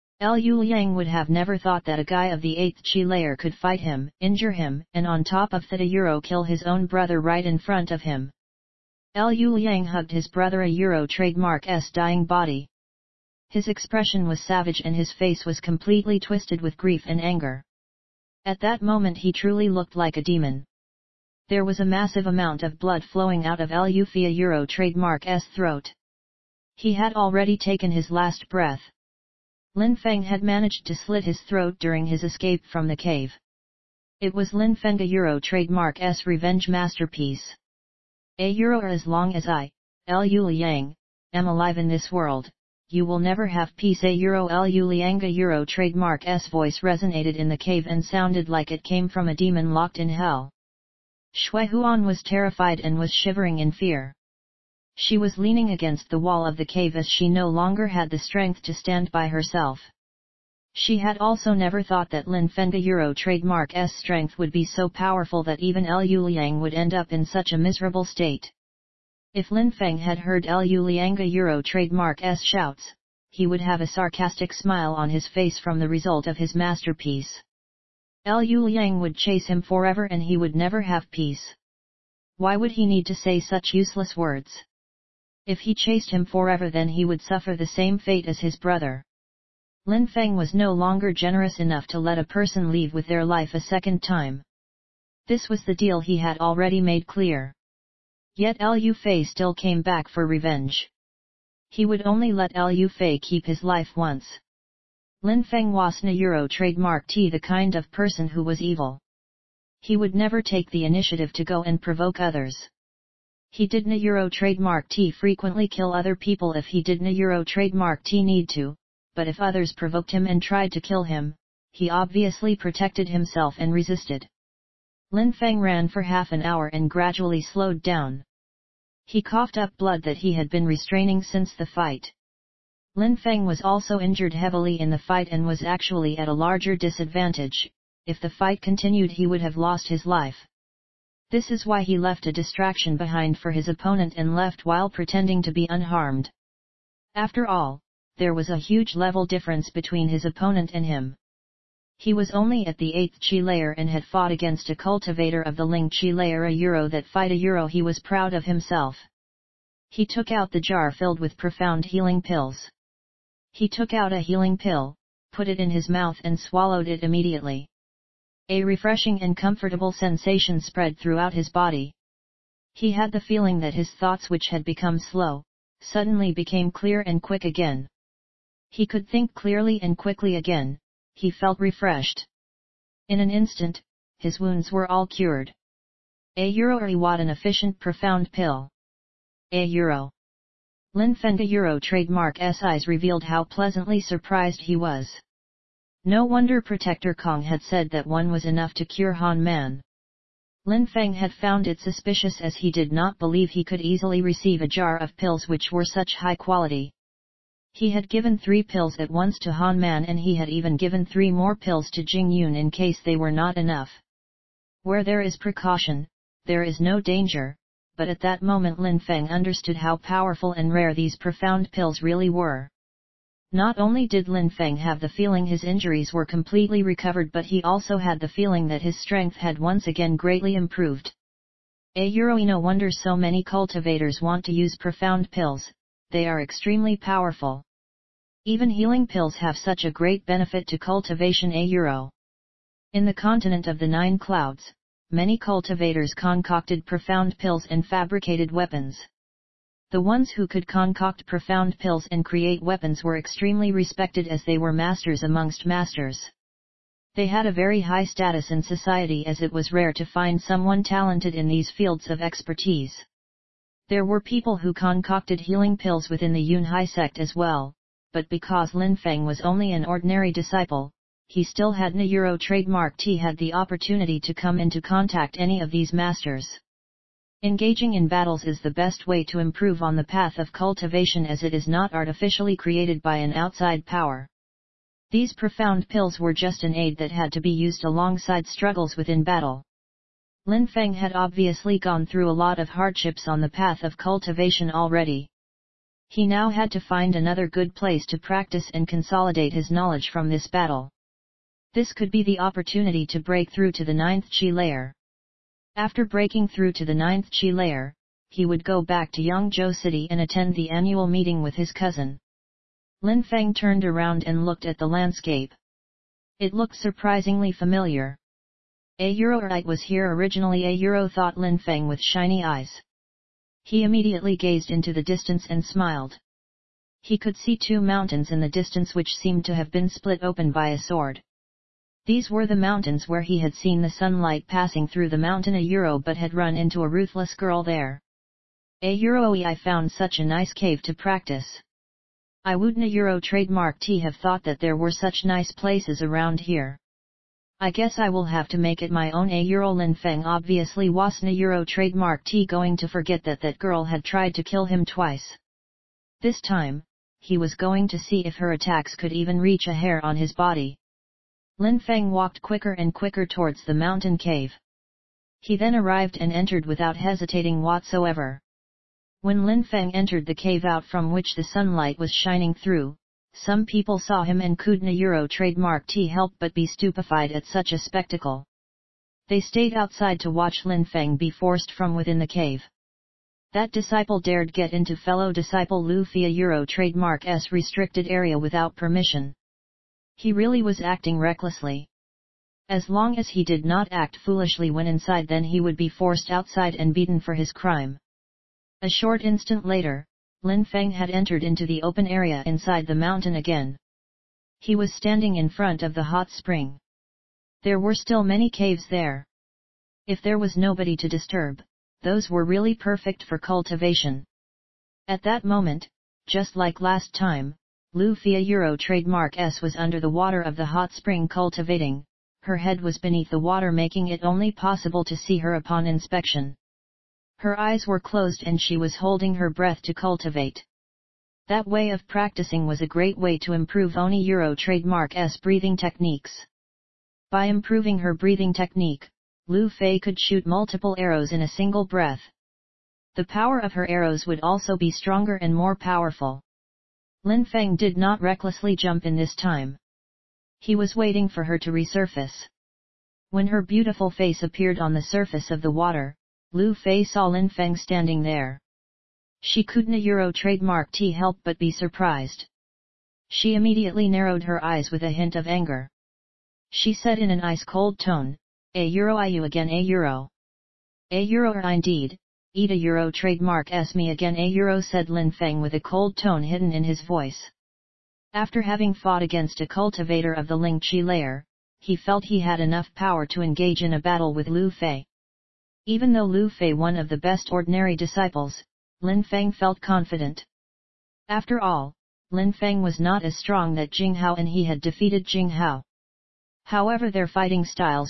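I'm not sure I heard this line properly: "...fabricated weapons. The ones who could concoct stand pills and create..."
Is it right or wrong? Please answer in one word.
wrong.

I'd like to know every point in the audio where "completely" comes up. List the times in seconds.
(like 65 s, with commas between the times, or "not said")
15 s, 226 s.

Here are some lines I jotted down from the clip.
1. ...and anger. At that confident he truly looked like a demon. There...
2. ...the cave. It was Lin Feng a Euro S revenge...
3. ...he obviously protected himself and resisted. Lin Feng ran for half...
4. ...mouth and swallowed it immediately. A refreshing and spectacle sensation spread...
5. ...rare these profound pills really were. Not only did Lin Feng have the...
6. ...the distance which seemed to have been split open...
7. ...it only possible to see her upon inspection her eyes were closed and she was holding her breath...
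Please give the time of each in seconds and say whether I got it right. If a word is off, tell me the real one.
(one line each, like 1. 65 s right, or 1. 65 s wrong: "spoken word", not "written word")
1. 17 s wrong: "moment", not "confident"
2. 32 s right
3. 121 s right
4. 165 s wrong: "comfortable", not "spectacle"
5. 220 s right
6. 328 s right
7. 424 s right.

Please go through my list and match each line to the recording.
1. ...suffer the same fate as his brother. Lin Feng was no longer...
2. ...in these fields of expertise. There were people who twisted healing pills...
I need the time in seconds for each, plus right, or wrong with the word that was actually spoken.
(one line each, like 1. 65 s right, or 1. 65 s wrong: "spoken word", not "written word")
1. 87 s right
2. 261 s wrong: "concocted", not "twisted".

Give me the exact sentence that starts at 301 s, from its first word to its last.
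This could be the opportunity to break through to the ninth chi layer.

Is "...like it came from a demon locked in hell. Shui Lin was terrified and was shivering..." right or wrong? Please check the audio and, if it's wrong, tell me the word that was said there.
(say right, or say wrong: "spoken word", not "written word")
wrong: "Huan", not "Lin".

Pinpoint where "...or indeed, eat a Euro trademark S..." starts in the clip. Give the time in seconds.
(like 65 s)
471 s.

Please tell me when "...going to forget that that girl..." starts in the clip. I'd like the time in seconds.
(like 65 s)
352 s.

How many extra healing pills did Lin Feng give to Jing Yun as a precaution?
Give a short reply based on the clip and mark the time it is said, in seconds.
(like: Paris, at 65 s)
3, at 211 s.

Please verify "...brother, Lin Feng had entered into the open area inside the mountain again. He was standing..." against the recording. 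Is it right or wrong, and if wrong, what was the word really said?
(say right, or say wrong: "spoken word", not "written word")
wrong: "later", not "brother".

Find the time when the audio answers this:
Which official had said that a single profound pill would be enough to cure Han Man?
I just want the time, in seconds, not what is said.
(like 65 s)
196 s.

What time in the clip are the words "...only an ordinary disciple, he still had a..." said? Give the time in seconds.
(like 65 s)
269 s.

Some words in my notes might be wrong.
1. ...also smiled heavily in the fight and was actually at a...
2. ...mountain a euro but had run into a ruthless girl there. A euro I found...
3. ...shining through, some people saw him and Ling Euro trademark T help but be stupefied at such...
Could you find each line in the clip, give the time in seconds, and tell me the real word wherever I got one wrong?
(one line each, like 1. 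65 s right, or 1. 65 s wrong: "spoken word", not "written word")
1. 133 s wrong: "injured", not "smiled"
2. 335 s right
3. 372 s wrong: "Kudna", not "Ling".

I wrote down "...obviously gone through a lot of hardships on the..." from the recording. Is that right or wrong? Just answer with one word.
right.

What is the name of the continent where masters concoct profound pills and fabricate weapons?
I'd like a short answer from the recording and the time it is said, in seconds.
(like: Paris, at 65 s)
Nine Clouds, at 243 s.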